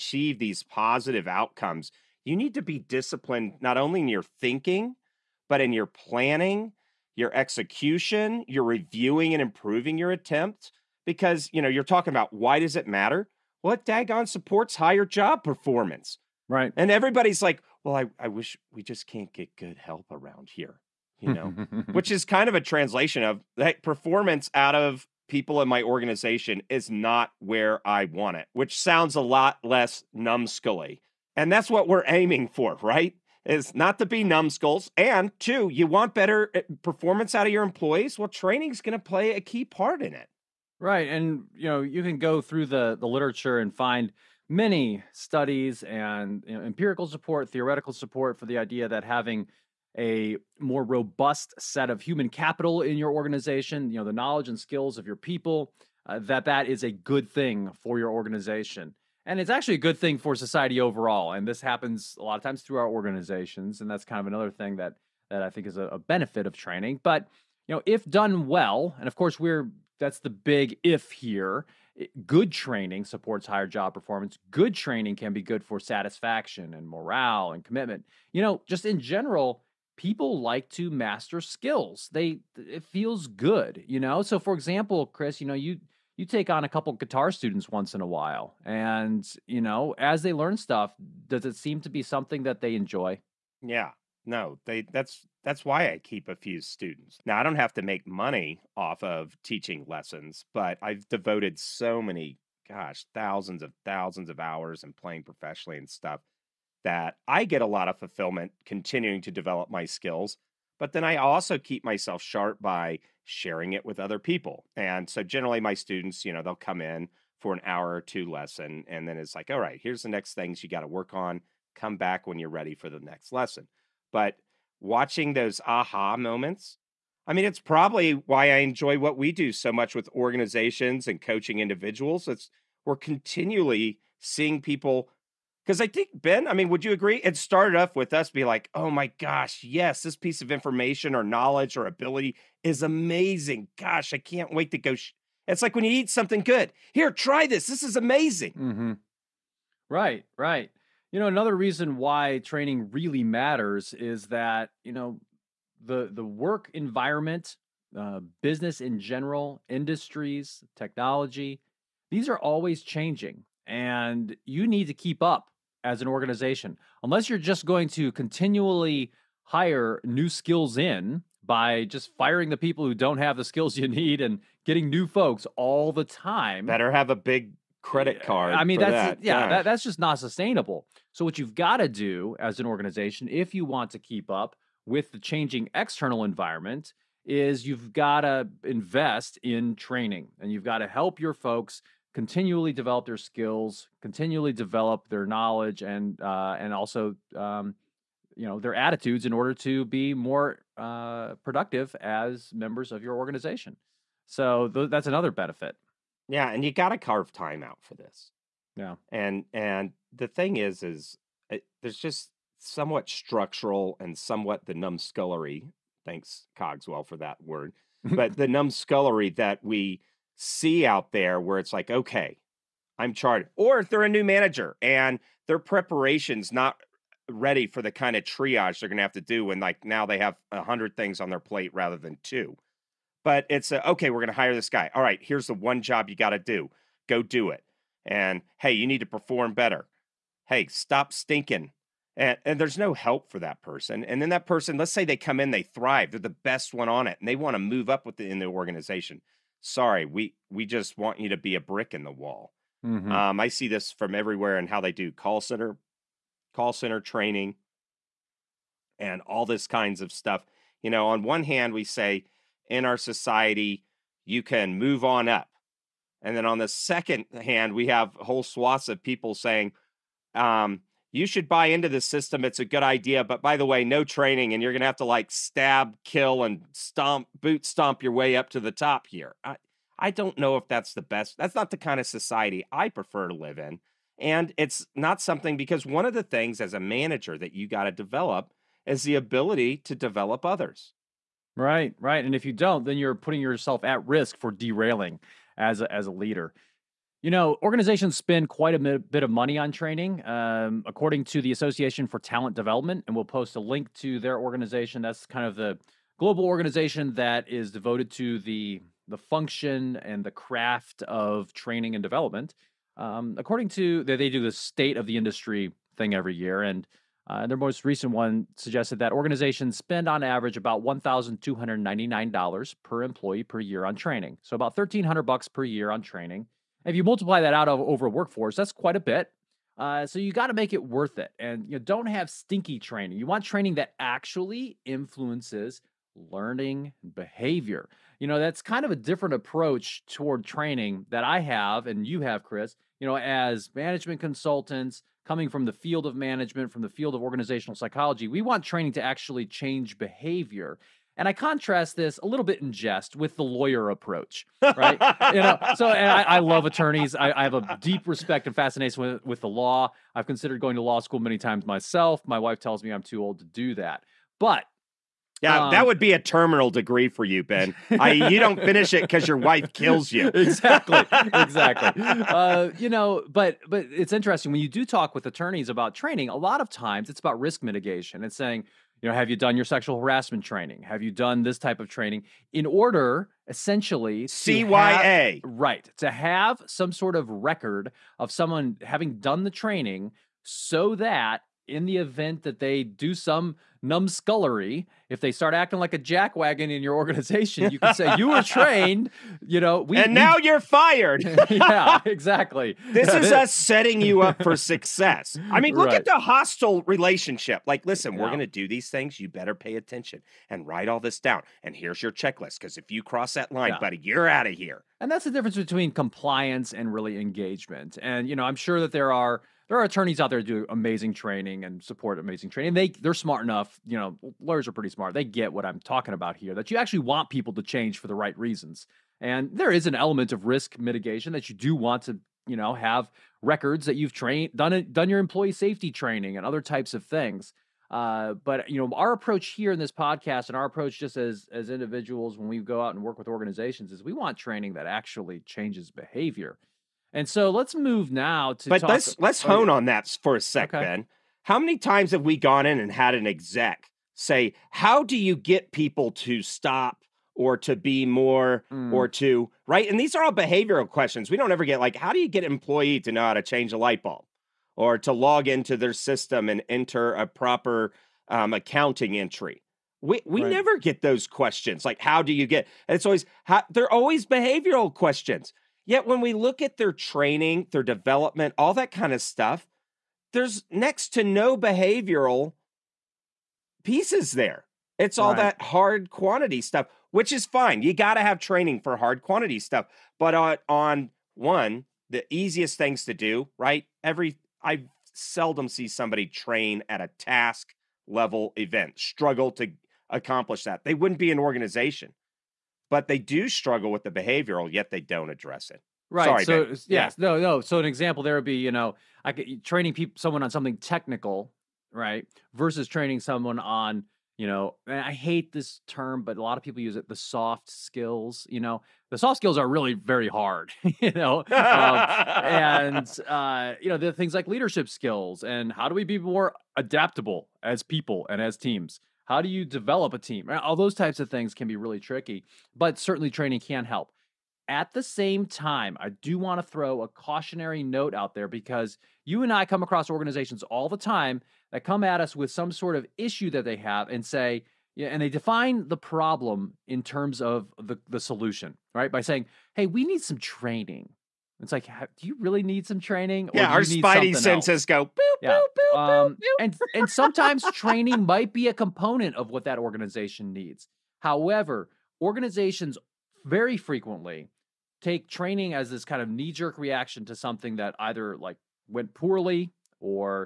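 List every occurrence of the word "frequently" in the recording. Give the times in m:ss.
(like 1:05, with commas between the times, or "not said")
9:23.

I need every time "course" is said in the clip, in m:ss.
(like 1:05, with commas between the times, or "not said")
1:09.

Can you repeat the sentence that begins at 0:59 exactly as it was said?
And it's actually a good thing for society overall.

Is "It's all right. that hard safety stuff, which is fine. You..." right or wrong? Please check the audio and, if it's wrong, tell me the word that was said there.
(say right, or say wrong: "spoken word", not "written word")
wrong: "quantity", not "safety".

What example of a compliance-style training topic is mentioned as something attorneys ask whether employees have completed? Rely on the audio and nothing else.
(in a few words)
Sexual harassment training.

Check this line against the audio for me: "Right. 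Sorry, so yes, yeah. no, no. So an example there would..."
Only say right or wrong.
right.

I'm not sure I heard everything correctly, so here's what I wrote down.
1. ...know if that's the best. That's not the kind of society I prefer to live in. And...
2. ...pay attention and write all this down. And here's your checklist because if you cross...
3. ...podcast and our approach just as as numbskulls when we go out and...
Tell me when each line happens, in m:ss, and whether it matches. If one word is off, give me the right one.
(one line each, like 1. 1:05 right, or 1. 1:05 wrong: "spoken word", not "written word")
1. 4:40 right
2. 6:49 right
3. 7:19 wrong: "individuals", not "numbskulls".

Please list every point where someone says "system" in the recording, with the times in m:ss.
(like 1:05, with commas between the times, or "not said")
4:32, 7:45.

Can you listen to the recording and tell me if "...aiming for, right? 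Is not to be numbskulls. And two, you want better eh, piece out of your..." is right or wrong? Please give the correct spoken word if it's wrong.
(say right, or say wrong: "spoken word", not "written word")
wrong: "performance", not "piece".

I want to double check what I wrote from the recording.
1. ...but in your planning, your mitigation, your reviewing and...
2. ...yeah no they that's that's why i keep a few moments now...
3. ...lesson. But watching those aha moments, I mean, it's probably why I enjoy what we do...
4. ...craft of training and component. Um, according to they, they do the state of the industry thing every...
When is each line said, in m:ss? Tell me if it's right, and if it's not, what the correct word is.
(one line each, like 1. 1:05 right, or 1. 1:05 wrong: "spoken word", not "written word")
1. 0:05 wrong: "execution", not "mitigation"
2. 1:33 wrong: "students", not "moments"
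3. 2:03 right
4. 5:10 wrong: "development", not "component".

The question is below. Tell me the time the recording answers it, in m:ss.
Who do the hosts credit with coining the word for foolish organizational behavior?
3:36.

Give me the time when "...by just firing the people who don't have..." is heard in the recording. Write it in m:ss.
2:51.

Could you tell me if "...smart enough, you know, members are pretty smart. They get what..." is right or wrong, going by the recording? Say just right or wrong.
wrong.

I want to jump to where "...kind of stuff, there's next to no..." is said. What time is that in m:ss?
7:58.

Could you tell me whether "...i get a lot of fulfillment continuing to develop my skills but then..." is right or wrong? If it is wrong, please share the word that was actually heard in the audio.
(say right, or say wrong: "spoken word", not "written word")
right.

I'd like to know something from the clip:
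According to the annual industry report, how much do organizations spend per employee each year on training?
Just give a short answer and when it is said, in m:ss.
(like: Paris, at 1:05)
$1,299, at 5:20.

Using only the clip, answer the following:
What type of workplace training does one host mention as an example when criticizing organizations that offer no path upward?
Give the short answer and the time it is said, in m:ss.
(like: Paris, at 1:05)
Call center training, at 4:16.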